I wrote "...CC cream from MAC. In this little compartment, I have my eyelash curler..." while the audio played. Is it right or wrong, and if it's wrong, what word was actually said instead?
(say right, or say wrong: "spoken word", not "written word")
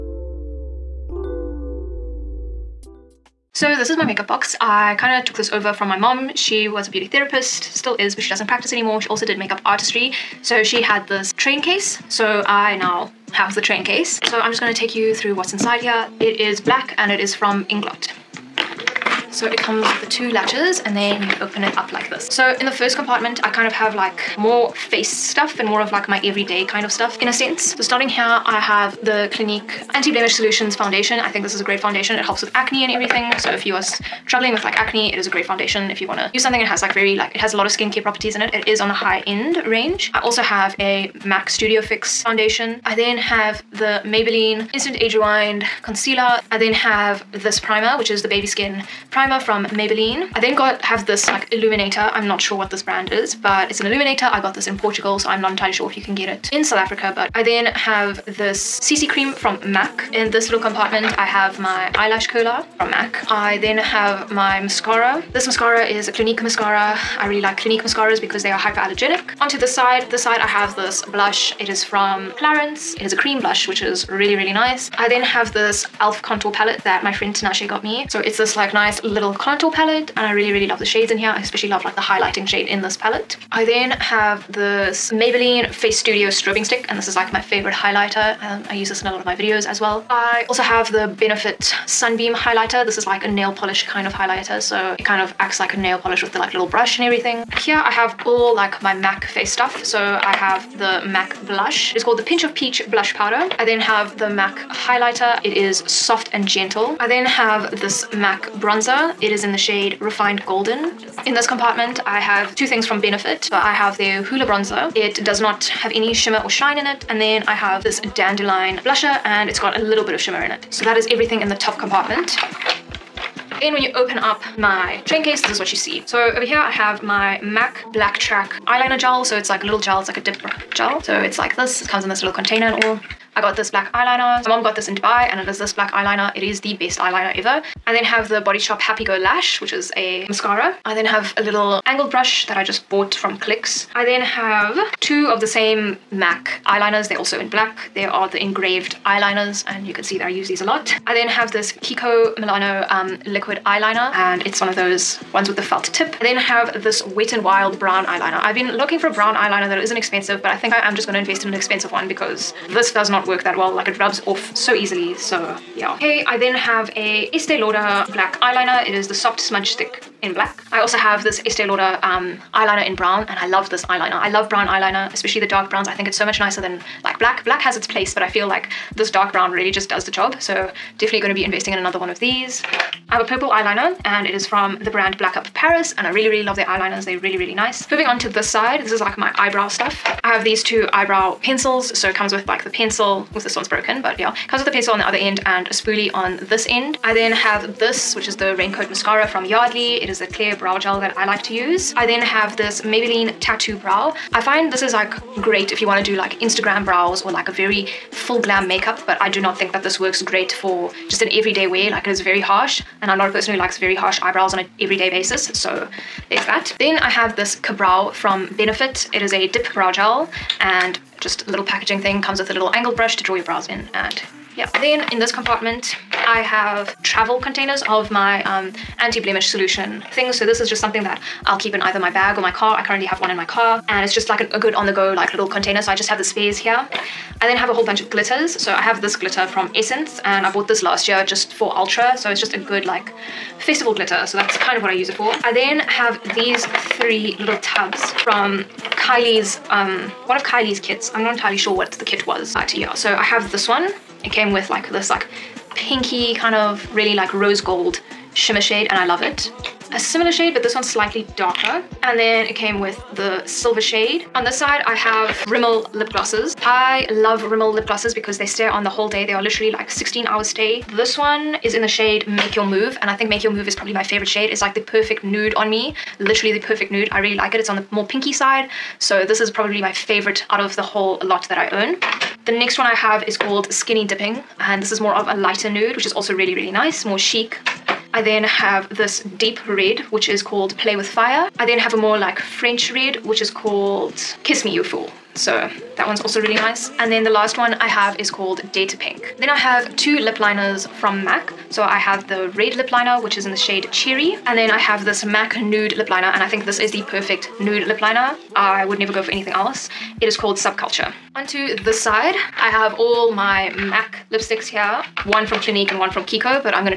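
right.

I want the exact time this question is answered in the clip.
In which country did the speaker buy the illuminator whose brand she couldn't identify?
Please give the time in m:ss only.
0:54.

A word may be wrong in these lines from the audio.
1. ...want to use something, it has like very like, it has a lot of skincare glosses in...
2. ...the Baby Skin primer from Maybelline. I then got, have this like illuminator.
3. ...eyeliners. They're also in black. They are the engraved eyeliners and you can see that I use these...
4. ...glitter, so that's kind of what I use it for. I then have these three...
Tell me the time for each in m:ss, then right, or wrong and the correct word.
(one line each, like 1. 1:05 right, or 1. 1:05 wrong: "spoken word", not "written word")
1. 0:36 wrong: "properties", not "glosses"
2. 0:48 right
3. 2:26 right
4. 4:03 right.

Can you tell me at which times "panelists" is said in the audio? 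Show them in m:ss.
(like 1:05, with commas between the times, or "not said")
not said.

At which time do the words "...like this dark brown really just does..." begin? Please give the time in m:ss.
2:58.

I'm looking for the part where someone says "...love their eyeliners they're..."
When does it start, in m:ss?
3:06.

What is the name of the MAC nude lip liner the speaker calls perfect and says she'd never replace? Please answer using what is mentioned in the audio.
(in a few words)
Subculture.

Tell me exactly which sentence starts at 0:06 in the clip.
She was a beauty therapist, still is, but she doesn't practice anymore.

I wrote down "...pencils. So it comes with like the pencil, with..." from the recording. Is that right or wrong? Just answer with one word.
right.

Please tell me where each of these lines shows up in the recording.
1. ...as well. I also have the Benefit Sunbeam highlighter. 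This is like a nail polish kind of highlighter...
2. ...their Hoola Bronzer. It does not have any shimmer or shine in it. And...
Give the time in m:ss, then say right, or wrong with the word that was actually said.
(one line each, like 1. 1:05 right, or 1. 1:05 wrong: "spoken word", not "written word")
1. 1:29 right
2. 1:53 right.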